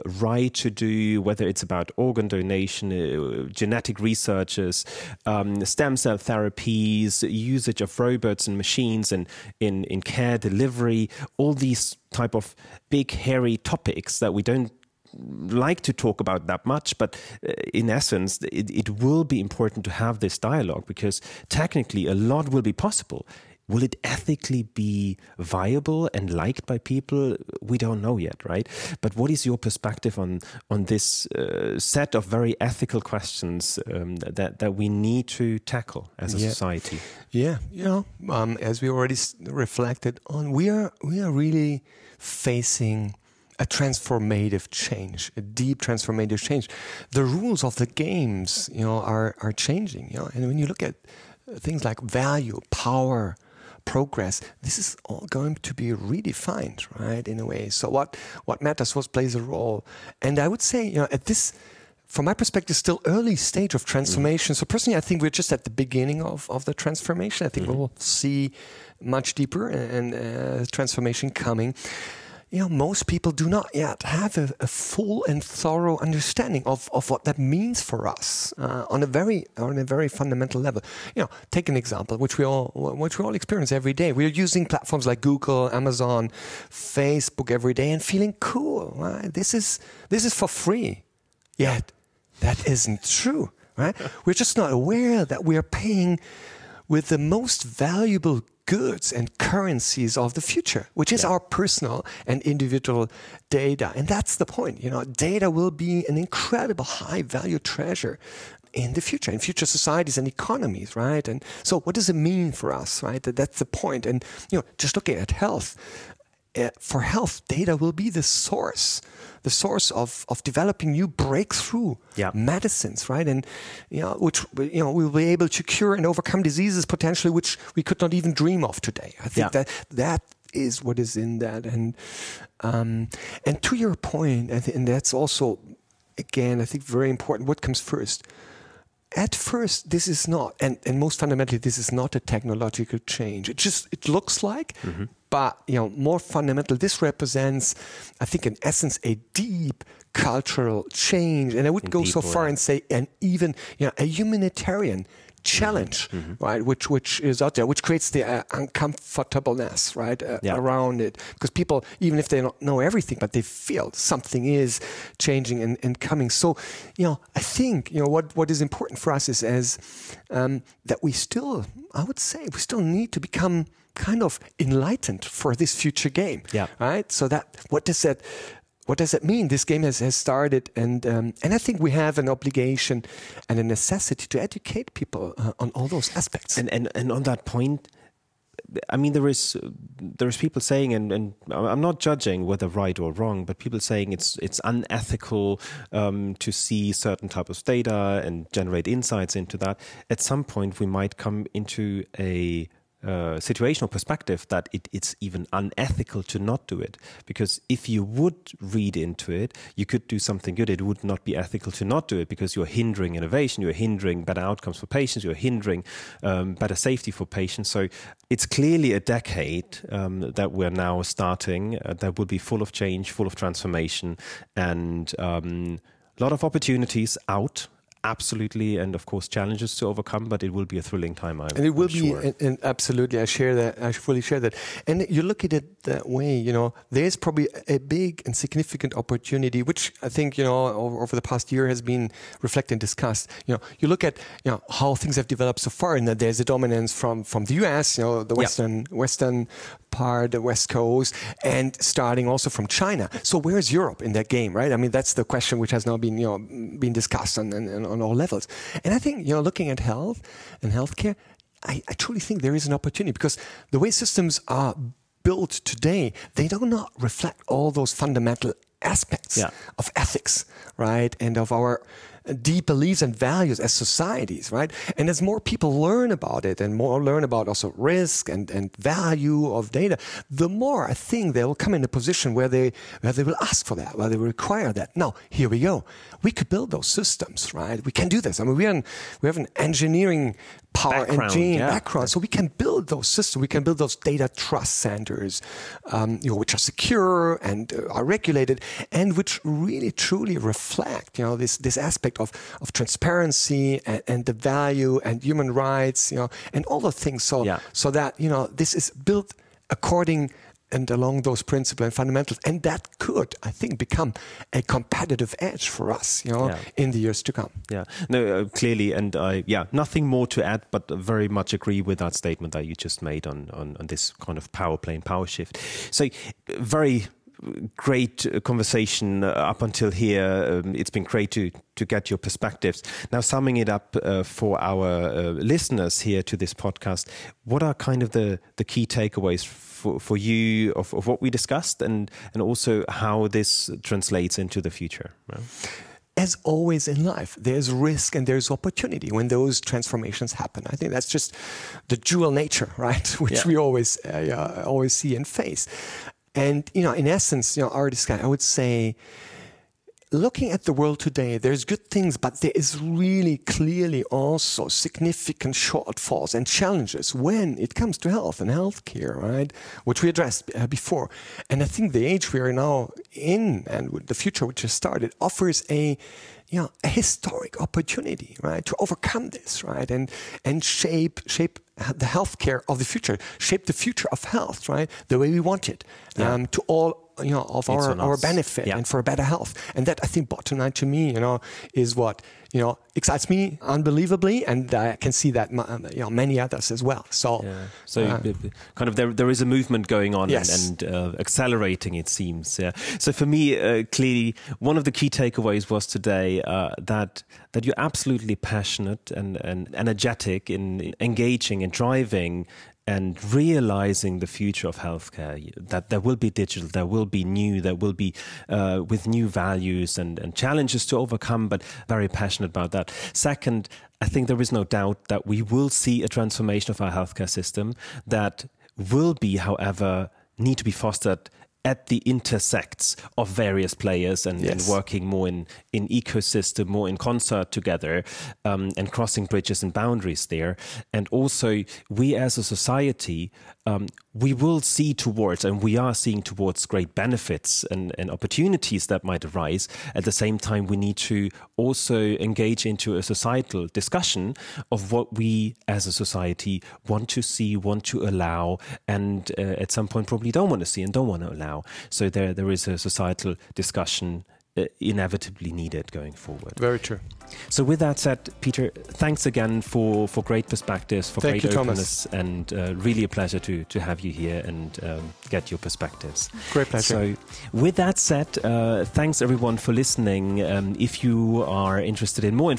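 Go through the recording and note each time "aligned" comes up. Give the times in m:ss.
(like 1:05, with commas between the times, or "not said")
not said.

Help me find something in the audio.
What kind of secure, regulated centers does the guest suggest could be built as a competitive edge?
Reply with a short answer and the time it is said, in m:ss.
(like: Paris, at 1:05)
data trust centers, at 4:53.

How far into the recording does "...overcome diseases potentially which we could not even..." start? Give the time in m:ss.
2:06.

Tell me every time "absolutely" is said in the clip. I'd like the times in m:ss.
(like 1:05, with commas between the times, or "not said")
3:48, 3:52, 6:47.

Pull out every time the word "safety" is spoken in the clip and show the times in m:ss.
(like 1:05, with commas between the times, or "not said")
3:36.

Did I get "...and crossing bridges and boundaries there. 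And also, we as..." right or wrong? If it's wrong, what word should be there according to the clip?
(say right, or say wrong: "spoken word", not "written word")
right.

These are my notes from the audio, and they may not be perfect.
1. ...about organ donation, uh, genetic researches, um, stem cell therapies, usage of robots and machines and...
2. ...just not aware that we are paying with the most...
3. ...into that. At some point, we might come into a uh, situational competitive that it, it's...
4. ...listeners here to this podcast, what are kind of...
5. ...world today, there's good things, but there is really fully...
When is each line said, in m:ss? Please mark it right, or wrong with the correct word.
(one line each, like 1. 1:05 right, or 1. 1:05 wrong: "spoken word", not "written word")
1. 0:01 right
2. 1:34 right
3. 3:19 wrong: "perspective", not "competitive"
4. 5:35 right
5. 6:00 wrong: "clearly", not "fully".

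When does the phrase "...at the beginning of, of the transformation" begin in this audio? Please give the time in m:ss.
1:05.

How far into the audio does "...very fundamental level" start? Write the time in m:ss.
1:19.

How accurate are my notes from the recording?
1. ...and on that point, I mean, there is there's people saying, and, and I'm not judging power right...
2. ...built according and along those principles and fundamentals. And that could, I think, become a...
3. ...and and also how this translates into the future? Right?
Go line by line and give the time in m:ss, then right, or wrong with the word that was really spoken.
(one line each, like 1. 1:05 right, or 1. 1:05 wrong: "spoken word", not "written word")
1. 3:06 wrong: "whether", not "power"
2. 5:08 right
3. 5:41 right.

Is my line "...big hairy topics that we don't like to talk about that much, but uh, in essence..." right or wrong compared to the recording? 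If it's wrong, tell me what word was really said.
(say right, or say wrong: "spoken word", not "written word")
right.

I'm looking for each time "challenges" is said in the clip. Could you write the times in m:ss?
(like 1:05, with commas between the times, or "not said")
2:35, 3:49, 6:06, 7:00.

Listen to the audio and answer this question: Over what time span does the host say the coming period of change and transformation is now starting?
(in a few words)
a decade.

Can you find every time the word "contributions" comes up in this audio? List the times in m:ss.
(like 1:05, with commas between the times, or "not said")
not said.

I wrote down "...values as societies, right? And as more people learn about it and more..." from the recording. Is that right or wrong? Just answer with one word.
right.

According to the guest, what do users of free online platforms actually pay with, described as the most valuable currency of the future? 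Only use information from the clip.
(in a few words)
personal and individual data.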